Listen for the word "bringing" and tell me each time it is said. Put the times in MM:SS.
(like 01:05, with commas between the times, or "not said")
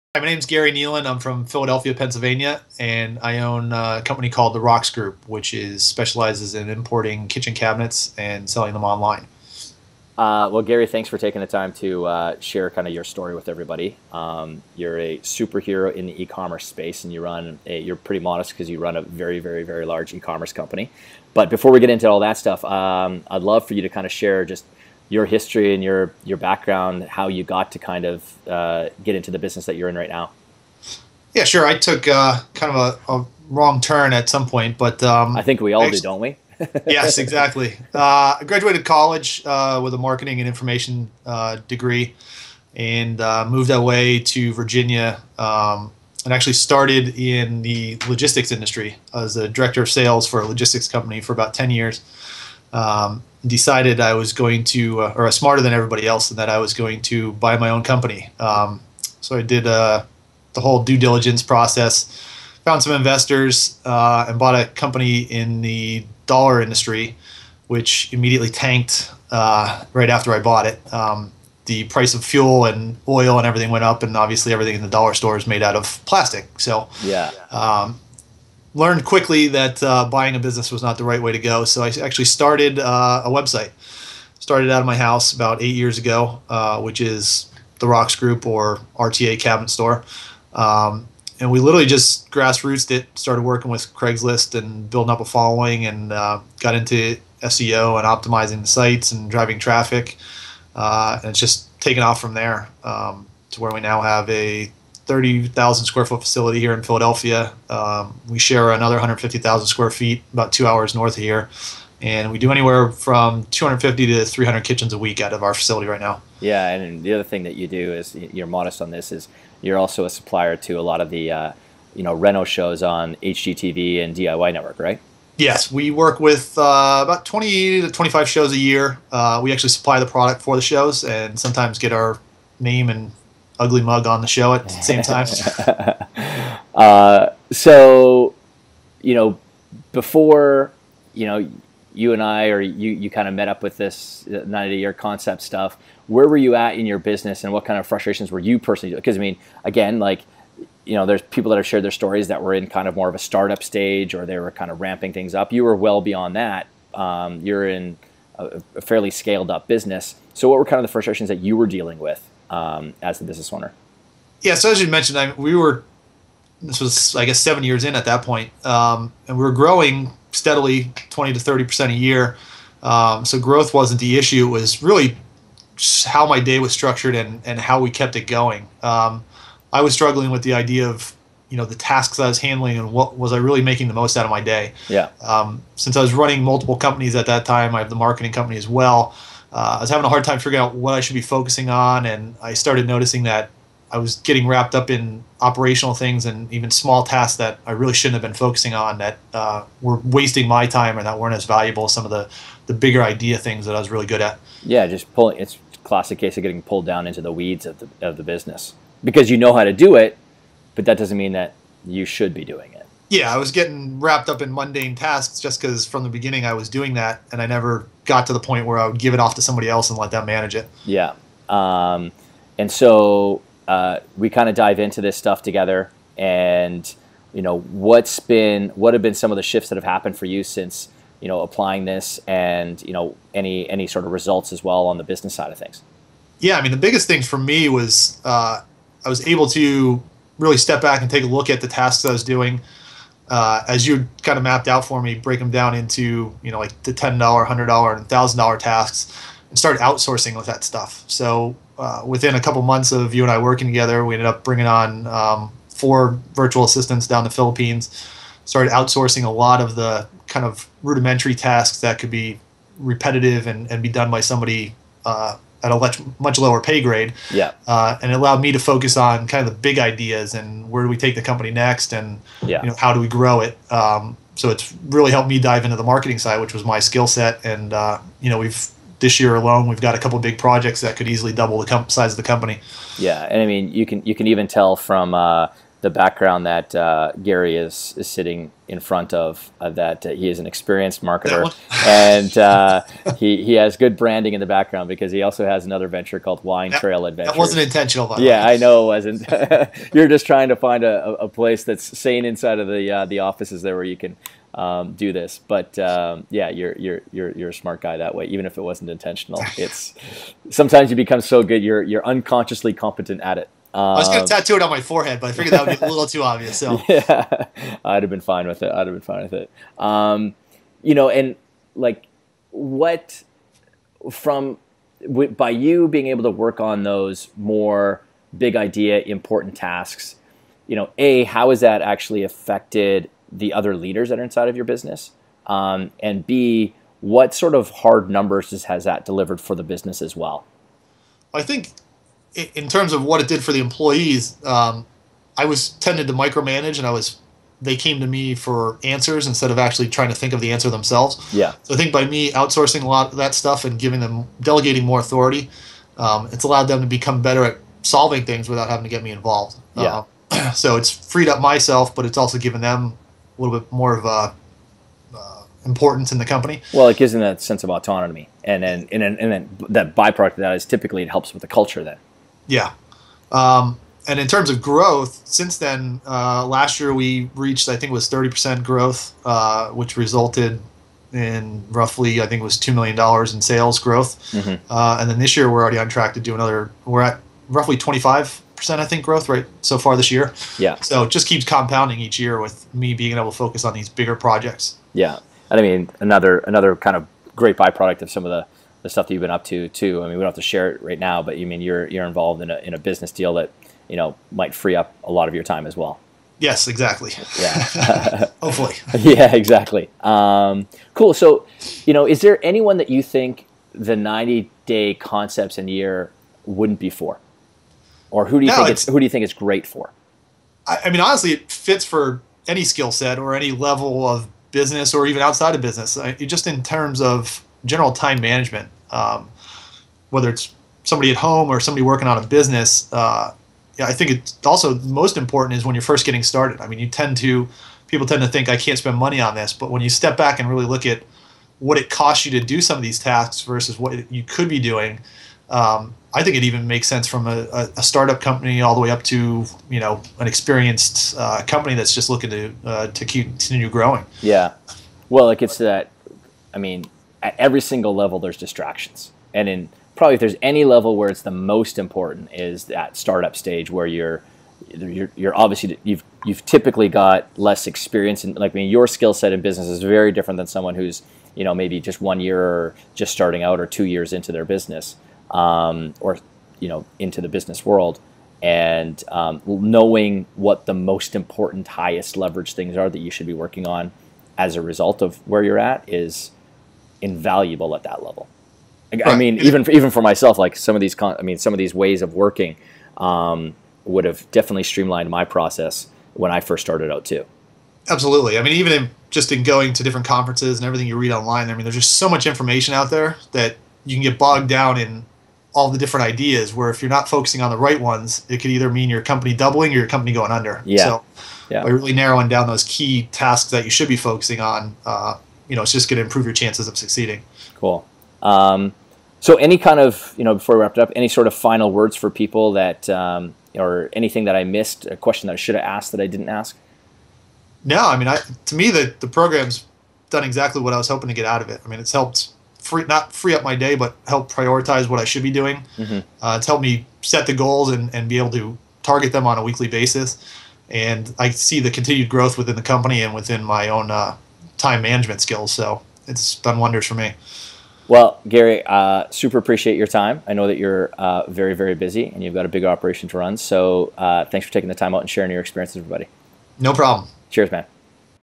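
04:14.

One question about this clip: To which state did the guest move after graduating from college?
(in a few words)
Virginia.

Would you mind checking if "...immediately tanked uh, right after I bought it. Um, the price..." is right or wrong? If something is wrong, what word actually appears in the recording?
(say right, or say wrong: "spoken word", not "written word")
right.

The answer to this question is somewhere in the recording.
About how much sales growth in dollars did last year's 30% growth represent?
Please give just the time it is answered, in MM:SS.
06:22.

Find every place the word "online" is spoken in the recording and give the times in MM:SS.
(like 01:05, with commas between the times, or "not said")
00:08, 08:21.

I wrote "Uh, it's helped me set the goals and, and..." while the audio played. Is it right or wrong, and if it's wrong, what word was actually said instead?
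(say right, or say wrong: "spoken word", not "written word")
right.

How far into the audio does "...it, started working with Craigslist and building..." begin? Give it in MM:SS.
01:32.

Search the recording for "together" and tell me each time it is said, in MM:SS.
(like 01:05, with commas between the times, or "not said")
03:45, 04:13.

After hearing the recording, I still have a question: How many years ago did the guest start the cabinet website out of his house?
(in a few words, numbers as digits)
8.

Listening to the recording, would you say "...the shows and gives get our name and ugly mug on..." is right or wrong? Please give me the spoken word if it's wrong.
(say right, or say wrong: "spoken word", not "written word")
wrong: "sometimes", not "gives".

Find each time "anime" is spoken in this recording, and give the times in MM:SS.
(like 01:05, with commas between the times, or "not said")
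not said.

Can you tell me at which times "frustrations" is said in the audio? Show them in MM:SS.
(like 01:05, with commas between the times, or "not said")
02:27, 02:40.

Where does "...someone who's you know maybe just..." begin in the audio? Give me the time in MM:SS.
07:50.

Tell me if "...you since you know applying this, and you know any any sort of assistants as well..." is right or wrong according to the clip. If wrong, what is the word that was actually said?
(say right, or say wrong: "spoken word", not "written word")
wrong: "results", not "assistants".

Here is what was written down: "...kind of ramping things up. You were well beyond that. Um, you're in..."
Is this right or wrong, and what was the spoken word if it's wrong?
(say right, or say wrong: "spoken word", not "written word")
right.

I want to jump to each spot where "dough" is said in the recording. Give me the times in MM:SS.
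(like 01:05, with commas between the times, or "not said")
not said.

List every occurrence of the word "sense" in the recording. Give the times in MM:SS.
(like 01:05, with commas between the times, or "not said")
06:07, 07:26.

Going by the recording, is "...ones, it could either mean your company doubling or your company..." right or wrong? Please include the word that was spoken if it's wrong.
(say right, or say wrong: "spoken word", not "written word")
right.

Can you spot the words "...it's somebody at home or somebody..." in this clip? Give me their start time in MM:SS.
07:10.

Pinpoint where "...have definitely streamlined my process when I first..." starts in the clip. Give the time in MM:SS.
08:14.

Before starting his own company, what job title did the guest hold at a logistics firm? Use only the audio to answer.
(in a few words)
Director of sales.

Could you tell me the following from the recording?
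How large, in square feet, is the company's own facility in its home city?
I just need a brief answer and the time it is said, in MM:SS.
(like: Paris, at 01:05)
30,000, at 01:45.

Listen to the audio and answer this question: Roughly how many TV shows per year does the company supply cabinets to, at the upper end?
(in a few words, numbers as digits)
25.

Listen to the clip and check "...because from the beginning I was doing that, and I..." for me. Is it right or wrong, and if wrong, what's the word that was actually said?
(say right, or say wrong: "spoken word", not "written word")
right.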